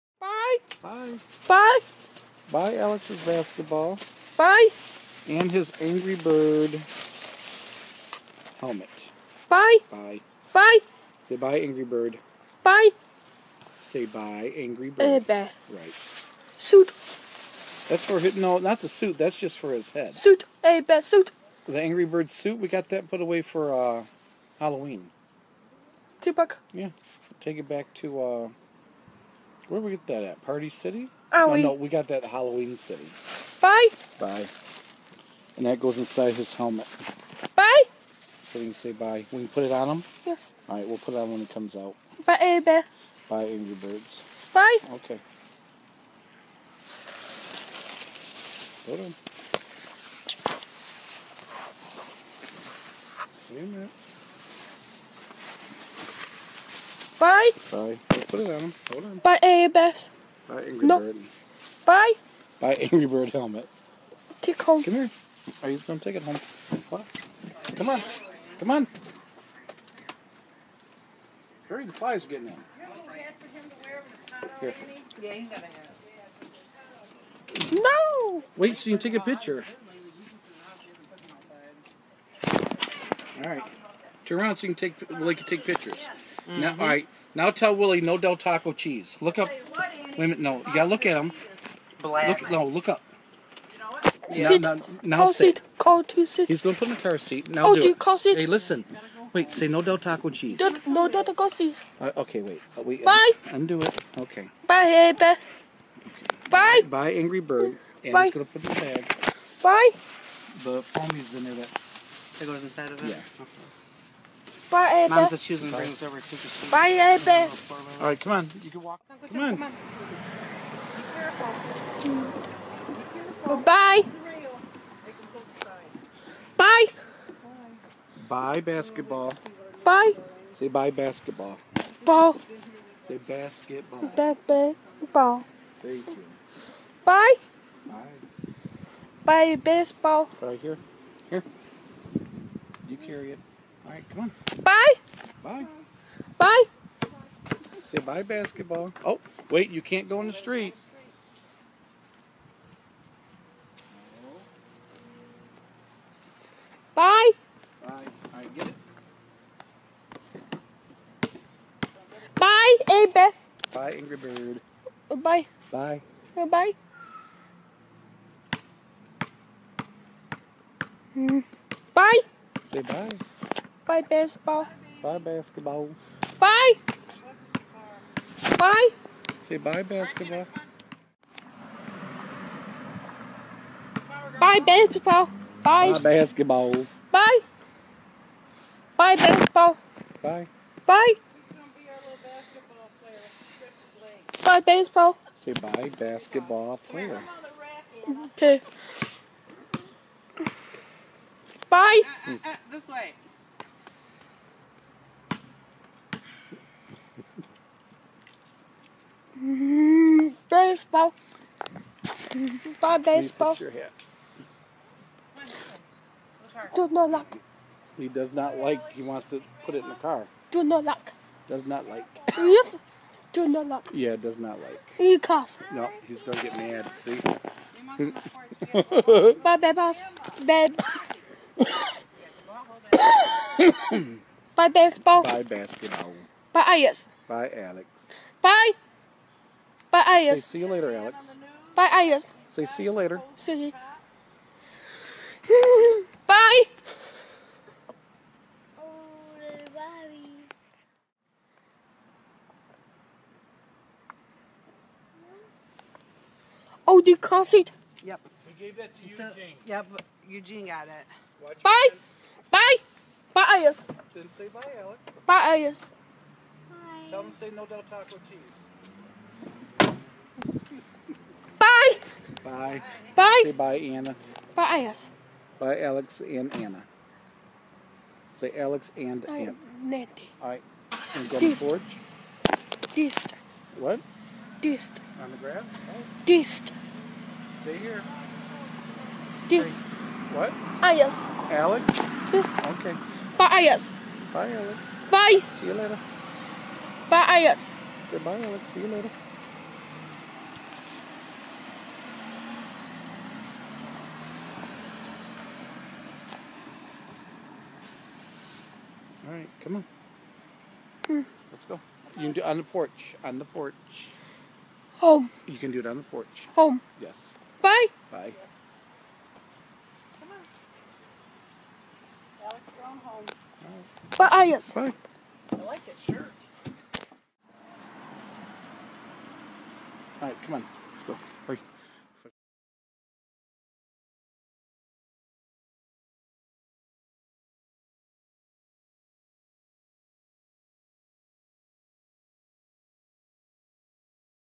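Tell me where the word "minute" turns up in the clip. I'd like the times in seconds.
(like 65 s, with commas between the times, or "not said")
53 s, 90 s.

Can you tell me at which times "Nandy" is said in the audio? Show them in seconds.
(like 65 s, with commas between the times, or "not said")
279 s.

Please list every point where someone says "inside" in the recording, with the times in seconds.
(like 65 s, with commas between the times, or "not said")
35 s, 112 s.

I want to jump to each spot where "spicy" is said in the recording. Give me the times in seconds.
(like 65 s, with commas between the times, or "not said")
not said.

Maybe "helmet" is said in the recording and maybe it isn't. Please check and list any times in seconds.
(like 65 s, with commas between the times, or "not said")
8 s, 36 s, 63 s.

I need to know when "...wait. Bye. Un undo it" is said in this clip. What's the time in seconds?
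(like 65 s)
102 s.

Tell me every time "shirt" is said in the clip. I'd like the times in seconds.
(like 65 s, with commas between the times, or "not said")
325 s.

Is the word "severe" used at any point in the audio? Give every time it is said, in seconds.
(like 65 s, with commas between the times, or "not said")
not said.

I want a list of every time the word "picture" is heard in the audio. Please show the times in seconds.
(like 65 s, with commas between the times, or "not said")
79 s, 85 s.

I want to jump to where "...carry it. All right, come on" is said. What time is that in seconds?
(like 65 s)
143 s.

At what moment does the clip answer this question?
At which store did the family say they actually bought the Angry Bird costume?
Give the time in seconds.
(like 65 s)
32 s.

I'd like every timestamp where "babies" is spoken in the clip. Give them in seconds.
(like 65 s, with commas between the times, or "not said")
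229 s.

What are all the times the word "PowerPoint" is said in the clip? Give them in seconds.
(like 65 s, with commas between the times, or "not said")
not said.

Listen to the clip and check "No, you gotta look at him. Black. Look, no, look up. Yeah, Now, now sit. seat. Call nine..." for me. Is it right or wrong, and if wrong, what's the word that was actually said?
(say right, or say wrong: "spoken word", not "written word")
wrong: "two", not "nine".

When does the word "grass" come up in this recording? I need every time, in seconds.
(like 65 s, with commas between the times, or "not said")
285 s.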